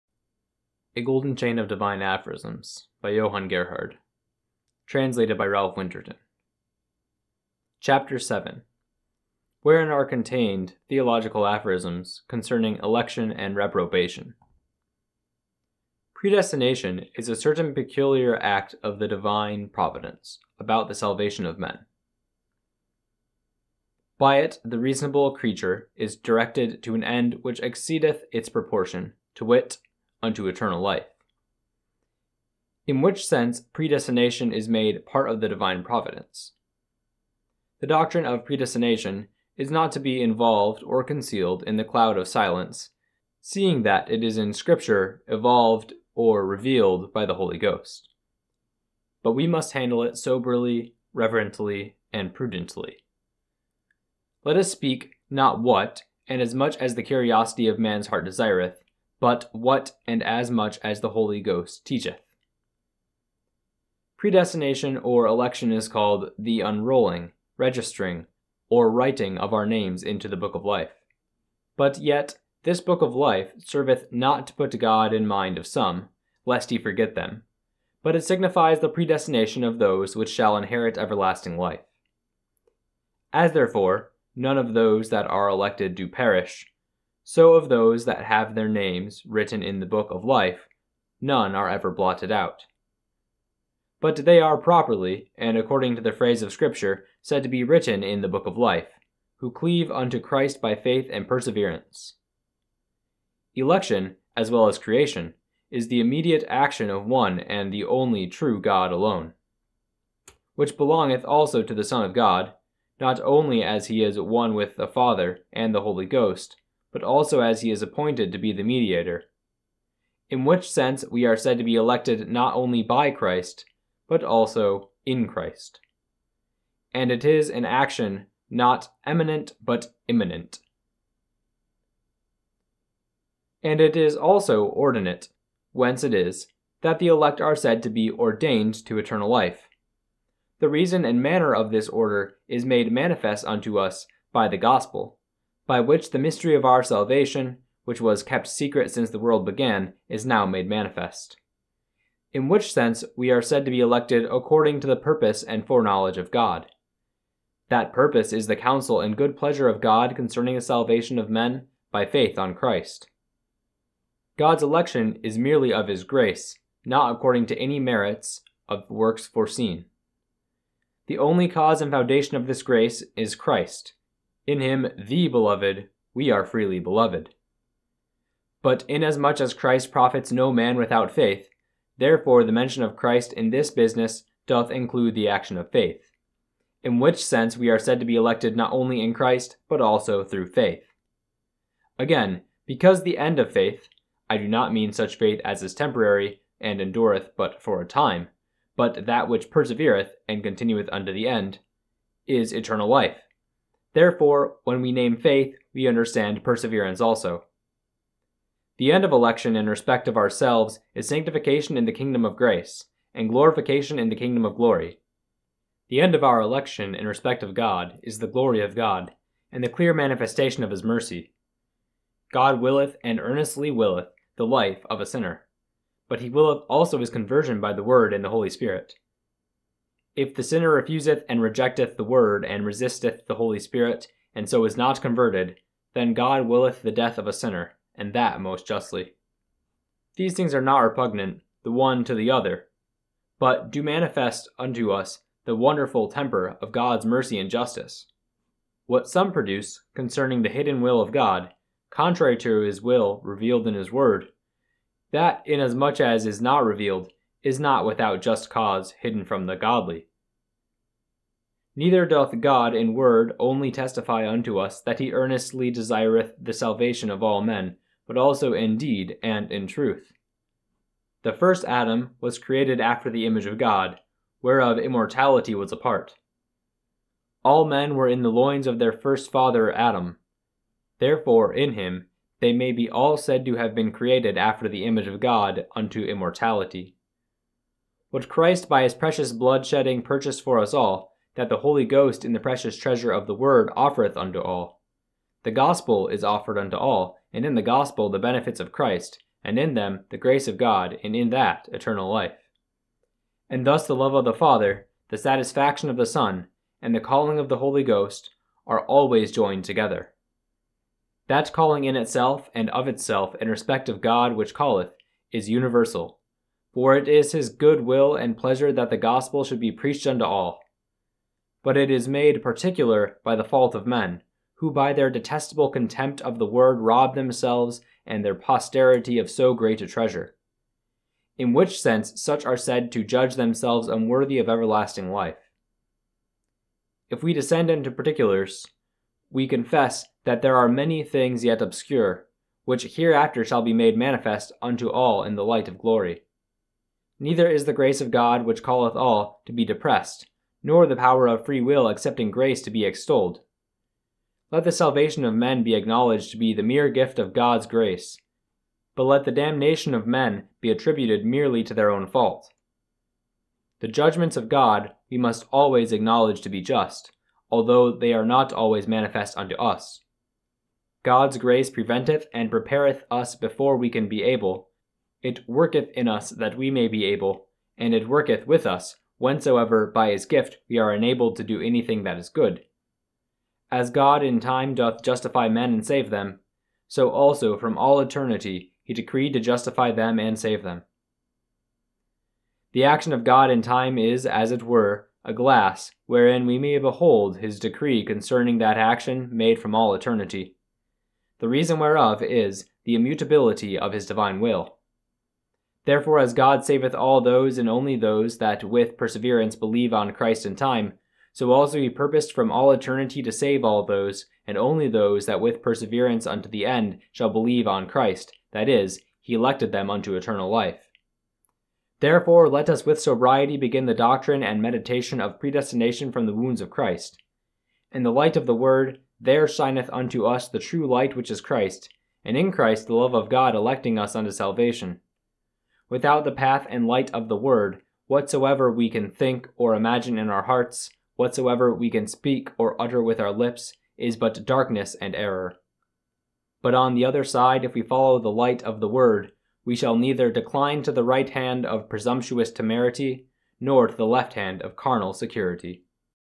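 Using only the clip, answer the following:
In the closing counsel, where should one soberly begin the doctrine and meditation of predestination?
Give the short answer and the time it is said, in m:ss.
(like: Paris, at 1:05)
The wounds of Christ, at 7:06.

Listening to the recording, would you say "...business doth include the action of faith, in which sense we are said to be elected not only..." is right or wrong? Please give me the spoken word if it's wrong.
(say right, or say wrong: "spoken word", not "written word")
right.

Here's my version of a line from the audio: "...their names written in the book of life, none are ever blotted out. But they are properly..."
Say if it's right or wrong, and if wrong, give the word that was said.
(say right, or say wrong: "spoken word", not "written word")
right.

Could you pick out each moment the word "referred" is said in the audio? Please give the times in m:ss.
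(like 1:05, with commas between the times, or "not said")
not said.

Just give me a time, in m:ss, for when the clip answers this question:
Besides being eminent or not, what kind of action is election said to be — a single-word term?
2:10.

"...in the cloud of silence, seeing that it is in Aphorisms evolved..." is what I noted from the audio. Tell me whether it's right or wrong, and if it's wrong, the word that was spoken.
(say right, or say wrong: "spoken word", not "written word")
wrong: "Scripture", not "Aphorisms".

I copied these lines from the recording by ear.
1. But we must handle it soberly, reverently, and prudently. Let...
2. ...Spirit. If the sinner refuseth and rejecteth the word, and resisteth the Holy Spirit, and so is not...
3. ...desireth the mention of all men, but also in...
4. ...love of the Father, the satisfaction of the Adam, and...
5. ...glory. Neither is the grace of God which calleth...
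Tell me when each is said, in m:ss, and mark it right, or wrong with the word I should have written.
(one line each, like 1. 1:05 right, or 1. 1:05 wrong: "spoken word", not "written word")
1. 0:49 right
2. 3:48 right
3. 4:25 wrong: "salvation", not "mention"
4. 5:03 wrong: "Son", not "Adam"
5. 5:45 right.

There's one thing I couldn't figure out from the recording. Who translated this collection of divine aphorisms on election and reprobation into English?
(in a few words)
Ralph Winterton.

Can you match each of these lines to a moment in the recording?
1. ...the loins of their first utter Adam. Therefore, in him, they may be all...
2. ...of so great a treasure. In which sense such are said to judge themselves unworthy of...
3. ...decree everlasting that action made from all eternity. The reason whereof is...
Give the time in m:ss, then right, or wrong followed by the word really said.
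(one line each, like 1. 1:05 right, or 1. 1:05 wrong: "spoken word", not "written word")
1. 4:38 wrong: "father", not "utter"
2. 5:29 right
3. 6:37 wrong: "concerning", not "everlasting".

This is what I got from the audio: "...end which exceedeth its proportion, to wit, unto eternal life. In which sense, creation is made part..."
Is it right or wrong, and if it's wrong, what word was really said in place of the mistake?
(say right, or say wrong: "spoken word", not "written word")
wrong: "predestination", not "creation".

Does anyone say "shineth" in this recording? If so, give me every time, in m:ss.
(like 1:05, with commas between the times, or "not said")
7:09.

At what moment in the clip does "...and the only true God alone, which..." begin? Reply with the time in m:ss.
1:47.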